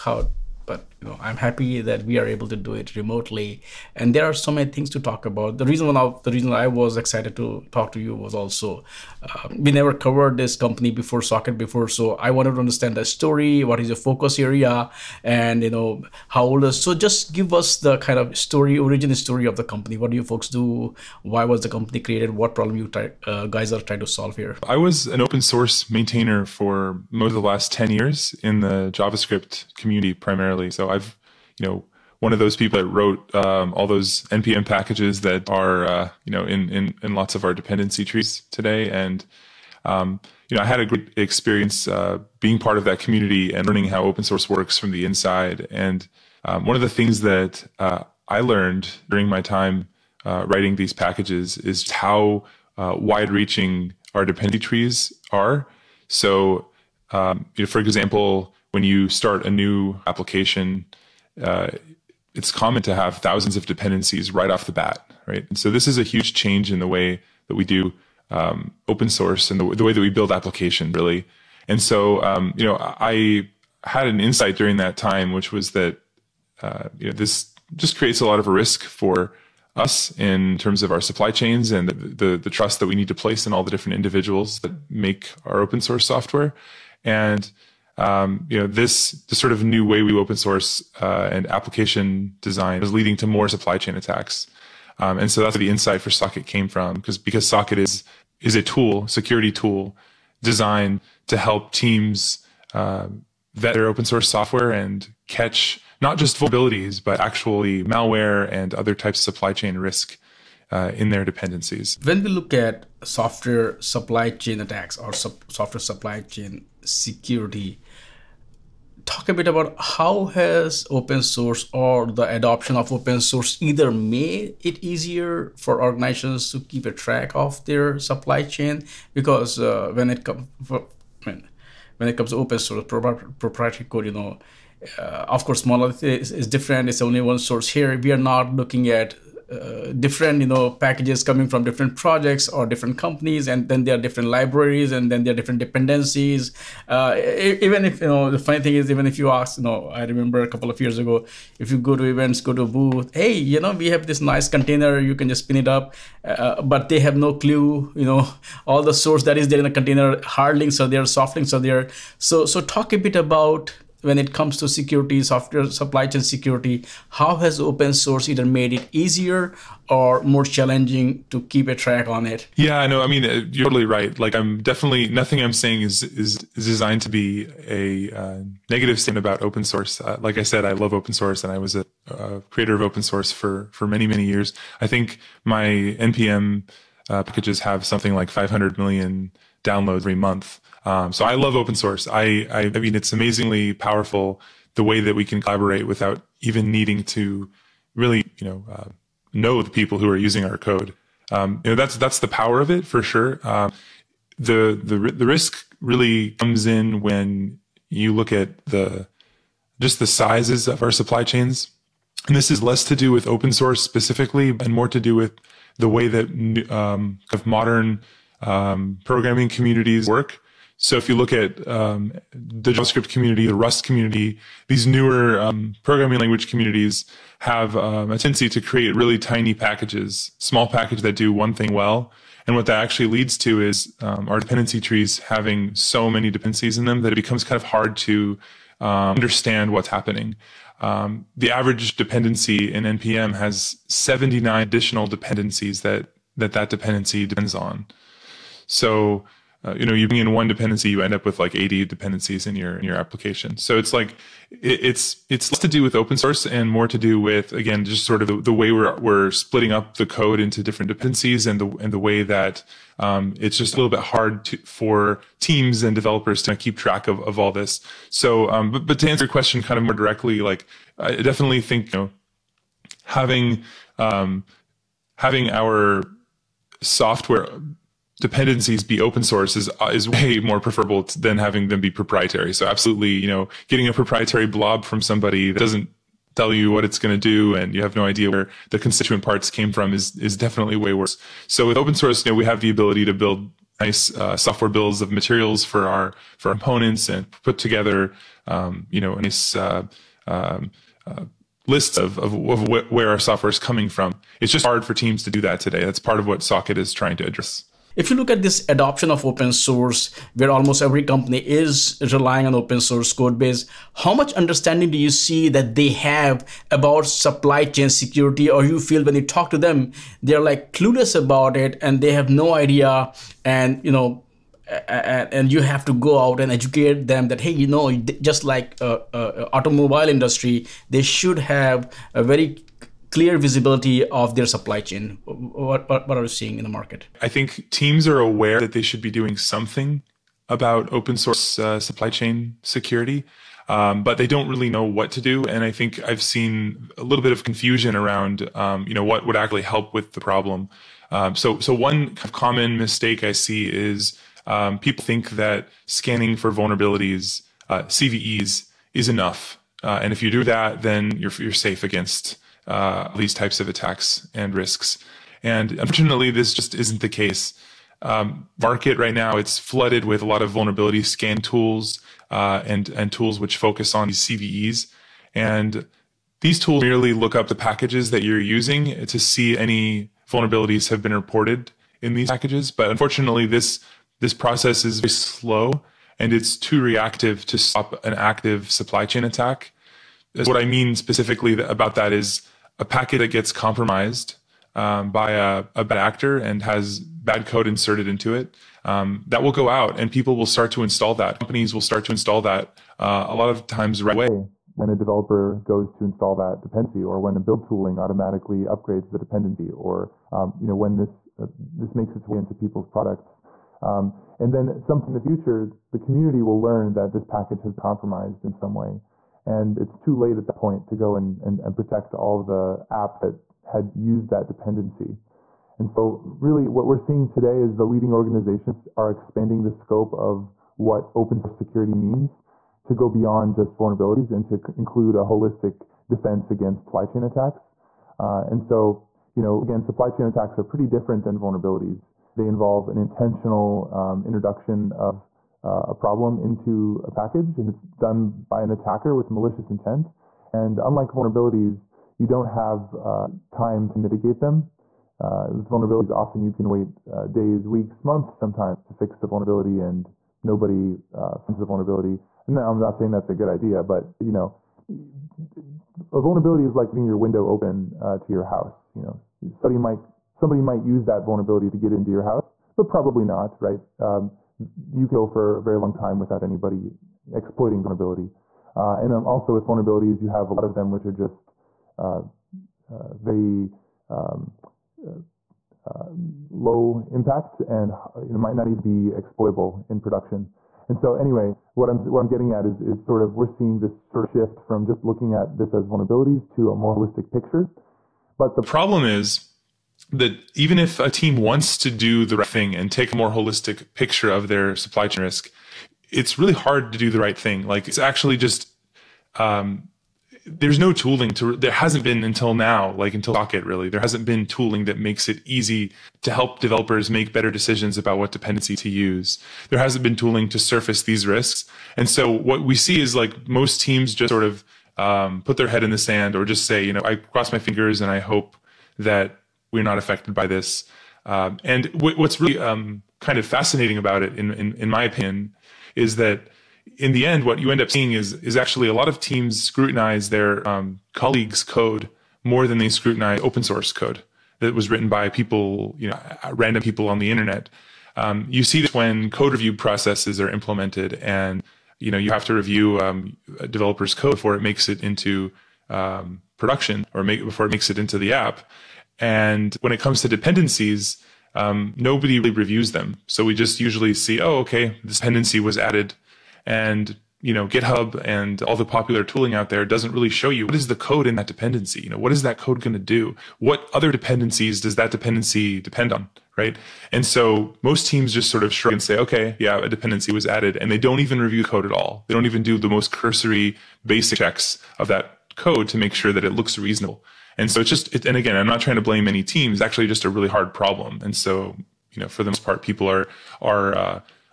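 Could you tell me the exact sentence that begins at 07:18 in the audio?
Uh, and so, you know, again, supply chain attacks are pretty different than vulnerabilities.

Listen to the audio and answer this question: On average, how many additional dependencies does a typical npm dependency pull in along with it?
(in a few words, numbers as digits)
79.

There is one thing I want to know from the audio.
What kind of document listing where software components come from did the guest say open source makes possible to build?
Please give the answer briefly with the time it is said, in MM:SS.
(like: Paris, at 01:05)
software bills of materials, at 04:54.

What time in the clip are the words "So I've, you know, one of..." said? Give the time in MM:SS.
00:30.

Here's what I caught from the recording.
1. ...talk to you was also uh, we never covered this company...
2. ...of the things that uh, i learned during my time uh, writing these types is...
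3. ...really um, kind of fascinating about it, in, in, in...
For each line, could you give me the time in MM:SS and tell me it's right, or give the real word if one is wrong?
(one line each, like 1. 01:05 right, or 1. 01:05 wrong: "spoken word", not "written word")
1. 00:07 right
2. 00:46 wrong: "packages", not "types"
3. 08:52 right.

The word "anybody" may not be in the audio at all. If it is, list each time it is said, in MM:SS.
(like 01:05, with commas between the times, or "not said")
07:56.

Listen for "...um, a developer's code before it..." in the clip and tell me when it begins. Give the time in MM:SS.
09:12.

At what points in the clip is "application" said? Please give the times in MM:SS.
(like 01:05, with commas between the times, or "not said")
01:00, 01:10, 01:31, 04:12.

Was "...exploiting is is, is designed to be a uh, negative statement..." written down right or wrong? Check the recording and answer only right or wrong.
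wrong.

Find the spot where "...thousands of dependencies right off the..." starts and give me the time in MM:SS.
01:03.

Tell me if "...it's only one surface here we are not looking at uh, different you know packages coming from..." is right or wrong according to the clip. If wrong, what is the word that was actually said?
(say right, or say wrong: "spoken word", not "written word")
wrong: "source", not "surface".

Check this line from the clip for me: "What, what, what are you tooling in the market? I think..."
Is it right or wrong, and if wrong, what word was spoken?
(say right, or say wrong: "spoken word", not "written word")
wrong: "seeing", not "tooling".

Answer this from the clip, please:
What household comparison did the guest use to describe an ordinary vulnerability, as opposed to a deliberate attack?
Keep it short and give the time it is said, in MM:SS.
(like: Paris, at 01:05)
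leaving your window open, at 07:46.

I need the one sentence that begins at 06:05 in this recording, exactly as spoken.
And unfortunately, this just isn't the case.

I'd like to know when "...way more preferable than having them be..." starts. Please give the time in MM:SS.
04:40.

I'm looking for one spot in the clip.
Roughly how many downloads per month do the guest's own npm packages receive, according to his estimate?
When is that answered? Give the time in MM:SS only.
03:08.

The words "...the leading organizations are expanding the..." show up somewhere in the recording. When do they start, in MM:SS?
07:07.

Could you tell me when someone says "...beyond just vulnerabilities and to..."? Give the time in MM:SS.
07:13.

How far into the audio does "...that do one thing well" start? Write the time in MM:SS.
03:51.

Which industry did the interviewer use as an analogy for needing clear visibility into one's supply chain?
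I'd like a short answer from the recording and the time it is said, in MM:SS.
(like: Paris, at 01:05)
automobile industry, at 05:29.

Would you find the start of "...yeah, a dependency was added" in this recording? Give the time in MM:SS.
09:39.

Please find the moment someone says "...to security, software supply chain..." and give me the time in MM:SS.
02:44.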